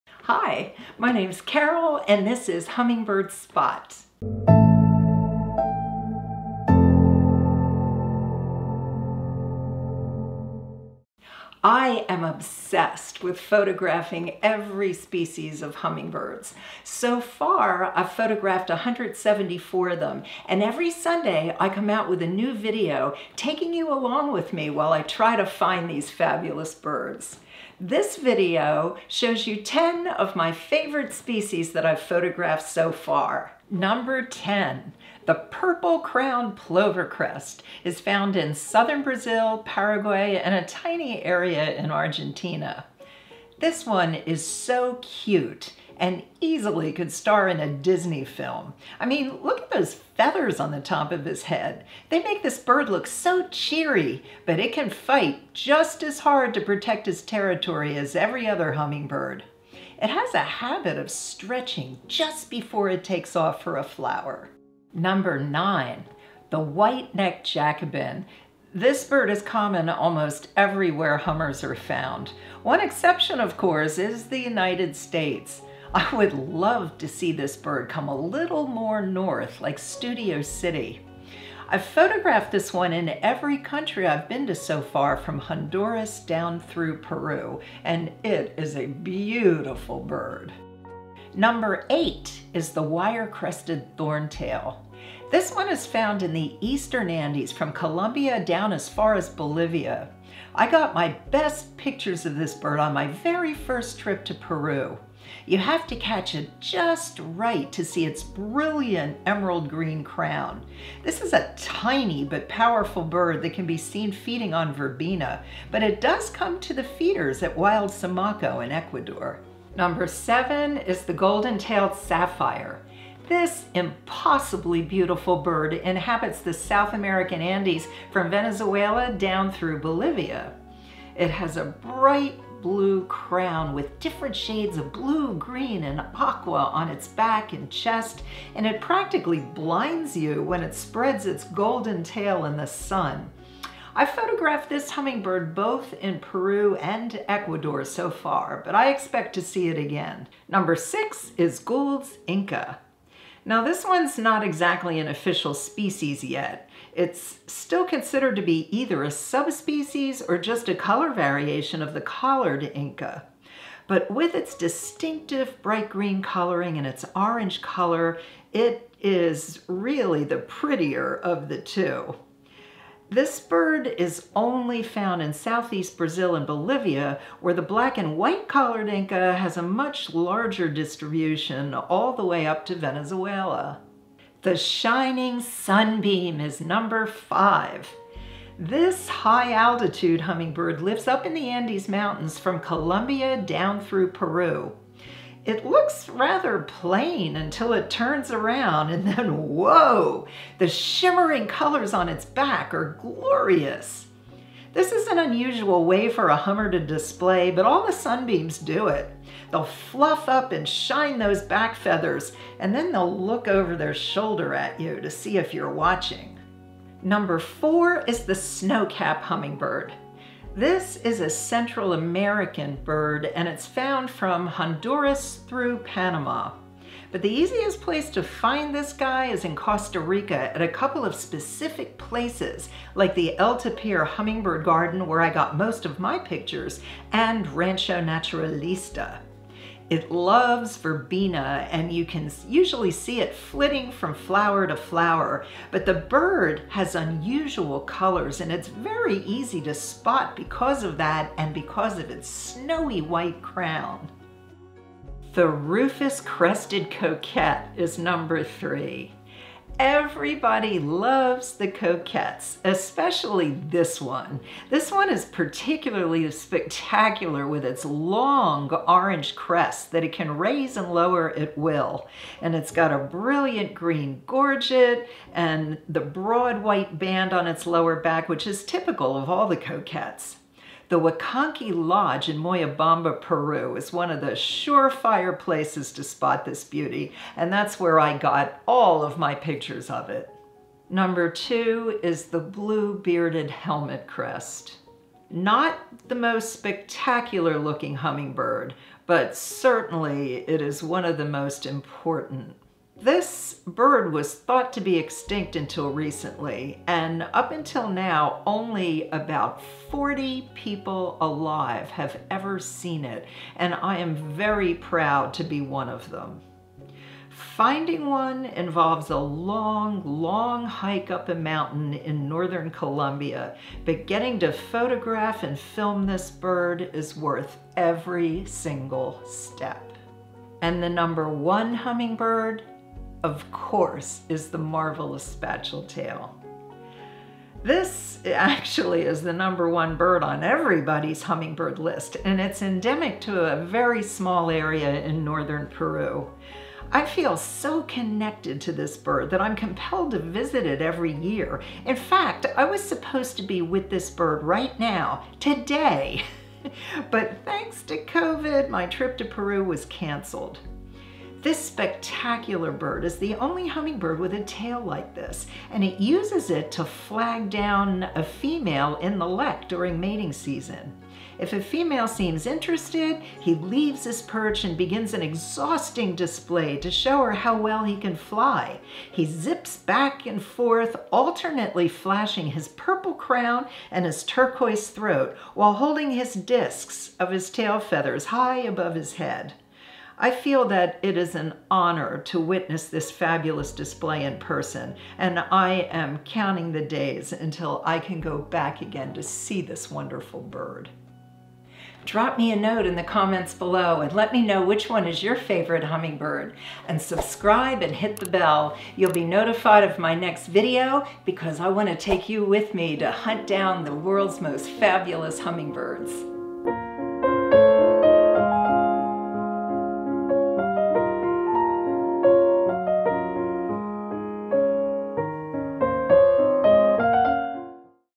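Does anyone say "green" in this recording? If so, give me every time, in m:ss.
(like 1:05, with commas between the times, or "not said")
1:49, 2:15, 2:45, 4:33.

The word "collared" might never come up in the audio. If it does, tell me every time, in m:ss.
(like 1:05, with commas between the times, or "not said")
2:42, 2:58.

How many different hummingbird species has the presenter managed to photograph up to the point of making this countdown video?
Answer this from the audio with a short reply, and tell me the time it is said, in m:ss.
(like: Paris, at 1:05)
174, at 0:18.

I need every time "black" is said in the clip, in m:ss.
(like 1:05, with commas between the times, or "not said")
2:57.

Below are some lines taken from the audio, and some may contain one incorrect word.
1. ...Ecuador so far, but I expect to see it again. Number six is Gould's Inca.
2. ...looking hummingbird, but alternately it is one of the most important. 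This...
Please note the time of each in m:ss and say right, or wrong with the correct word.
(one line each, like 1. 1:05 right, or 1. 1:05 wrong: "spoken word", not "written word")
1. 2:27 right
2. 4:57 wrong: "certainly", not "alternately".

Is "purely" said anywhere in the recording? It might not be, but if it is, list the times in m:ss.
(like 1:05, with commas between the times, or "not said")
not said.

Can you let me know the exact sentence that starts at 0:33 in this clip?
Number 10, the purple crowned plovercrest is found in southern Brazil, Paraguay, and a tiny area in Argentina.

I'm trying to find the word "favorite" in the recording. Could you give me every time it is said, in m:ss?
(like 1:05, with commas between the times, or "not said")
0:30, 6:45.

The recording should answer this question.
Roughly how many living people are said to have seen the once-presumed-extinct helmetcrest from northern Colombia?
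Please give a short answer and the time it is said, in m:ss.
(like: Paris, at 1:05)
40, at 5:09.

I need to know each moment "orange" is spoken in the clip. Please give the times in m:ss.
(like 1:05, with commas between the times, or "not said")
2:47, 4:28.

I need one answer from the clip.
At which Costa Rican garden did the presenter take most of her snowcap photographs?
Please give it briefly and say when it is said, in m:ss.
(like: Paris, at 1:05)
El Tapir Hummingbird Garden, at 3:53.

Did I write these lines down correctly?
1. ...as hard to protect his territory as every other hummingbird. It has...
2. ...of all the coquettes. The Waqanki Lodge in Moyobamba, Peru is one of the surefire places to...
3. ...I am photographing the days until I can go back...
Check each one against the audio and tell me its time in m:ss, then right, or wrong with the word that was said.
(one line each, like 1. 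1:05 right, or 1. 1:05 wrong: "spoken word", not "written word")
1. 0:56 right
2. 4:39 right
3. 6:35 wrong: "counting", not "photographing".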